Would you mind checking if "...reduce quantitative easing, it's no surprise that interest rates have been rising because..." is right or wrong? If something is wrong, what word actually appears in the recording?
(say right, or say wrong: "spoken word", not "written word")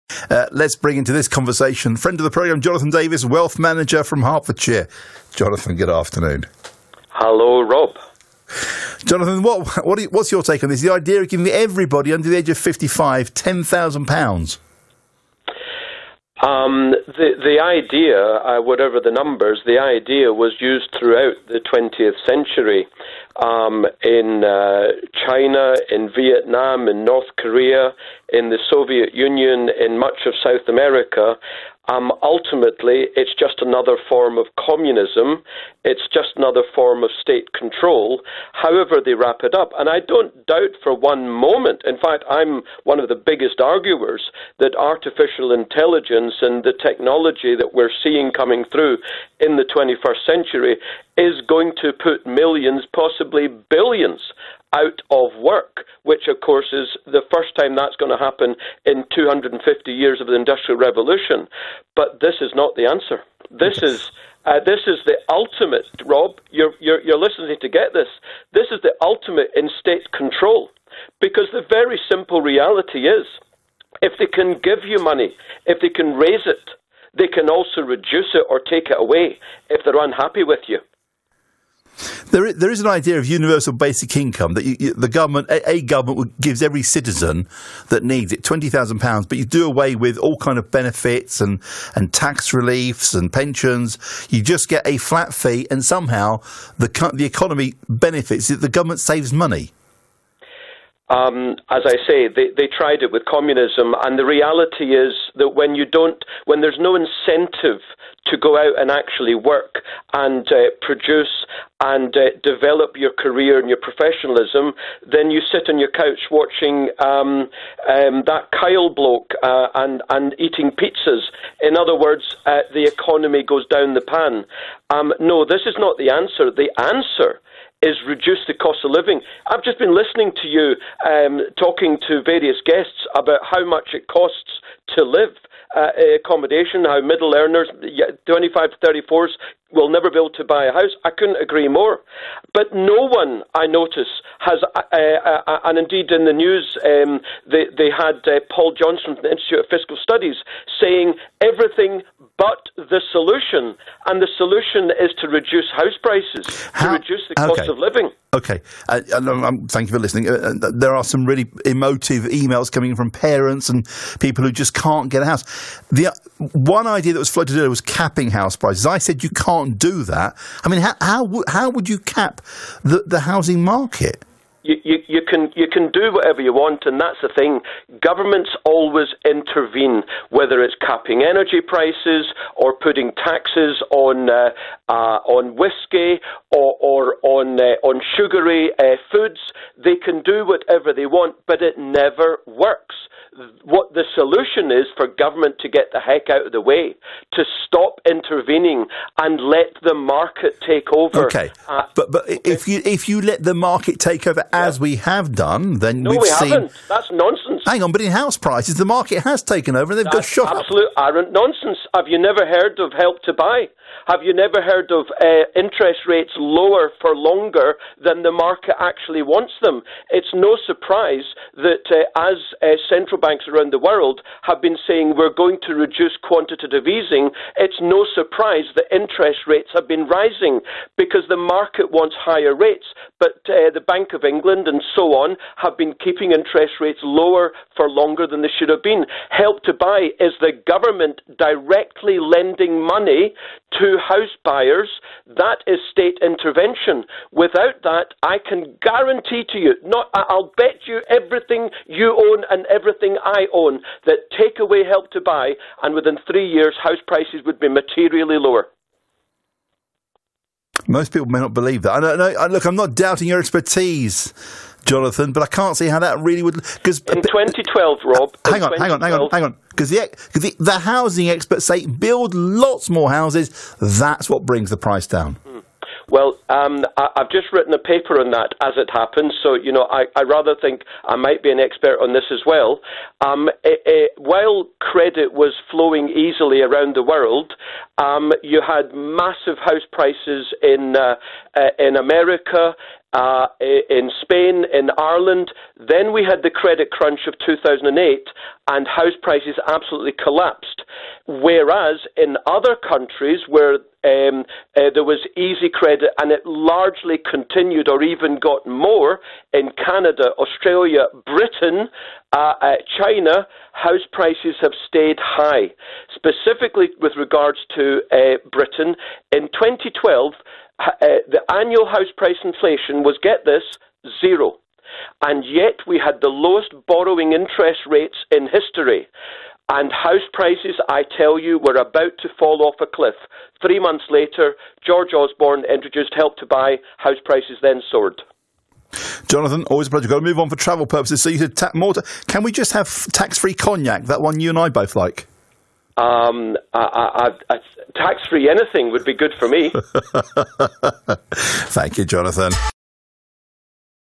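right.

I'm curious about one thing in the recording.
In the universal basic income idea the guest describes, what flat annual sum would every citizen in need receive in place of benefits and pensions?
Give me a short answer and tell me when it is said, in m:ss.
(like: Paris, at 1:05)
£20,000, at 1:28.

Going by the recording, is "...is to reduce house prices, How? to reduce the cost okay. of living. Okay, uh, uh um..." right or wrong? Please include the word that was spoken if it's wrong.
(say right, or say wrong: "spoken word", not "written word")
right.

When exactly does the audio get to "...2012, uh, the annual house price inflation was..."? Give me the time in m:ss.
5:19.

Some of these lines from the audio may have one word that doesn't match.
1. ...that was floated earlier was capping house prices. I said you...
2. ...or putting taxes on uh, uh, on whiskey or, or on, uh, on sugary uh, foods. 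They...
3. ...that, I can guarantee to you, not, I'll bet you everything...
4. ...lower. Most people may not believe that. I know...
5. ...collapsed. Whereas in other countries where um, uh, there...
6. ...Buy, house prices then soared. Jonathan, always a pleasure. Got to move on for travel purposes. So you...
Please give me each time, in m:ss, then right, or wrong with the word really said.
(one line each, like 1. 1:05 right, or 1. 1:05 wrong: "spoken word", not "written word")
1. 2:47 right
2. 3:02 right
3. 4:07 right
4. 4:18 right
5. 5:00 right
6. 5:36 right.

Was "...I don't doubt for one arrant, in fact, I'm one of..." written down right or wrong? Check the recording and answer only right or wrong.
wrong.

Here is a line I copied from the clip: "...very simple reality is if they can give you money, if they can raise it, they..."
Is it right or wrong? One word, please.
right.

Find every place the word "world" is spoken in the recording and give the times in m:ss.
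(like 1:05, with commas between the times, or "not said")
3:43, 4:47.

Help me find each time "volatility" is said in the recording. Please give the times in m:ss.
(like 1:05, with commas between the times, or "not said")
not said.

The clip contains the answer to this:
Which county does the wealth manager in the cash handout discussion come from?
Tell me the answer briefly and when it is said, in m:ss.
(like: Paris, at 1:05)
Hertfordshire, at 0:04.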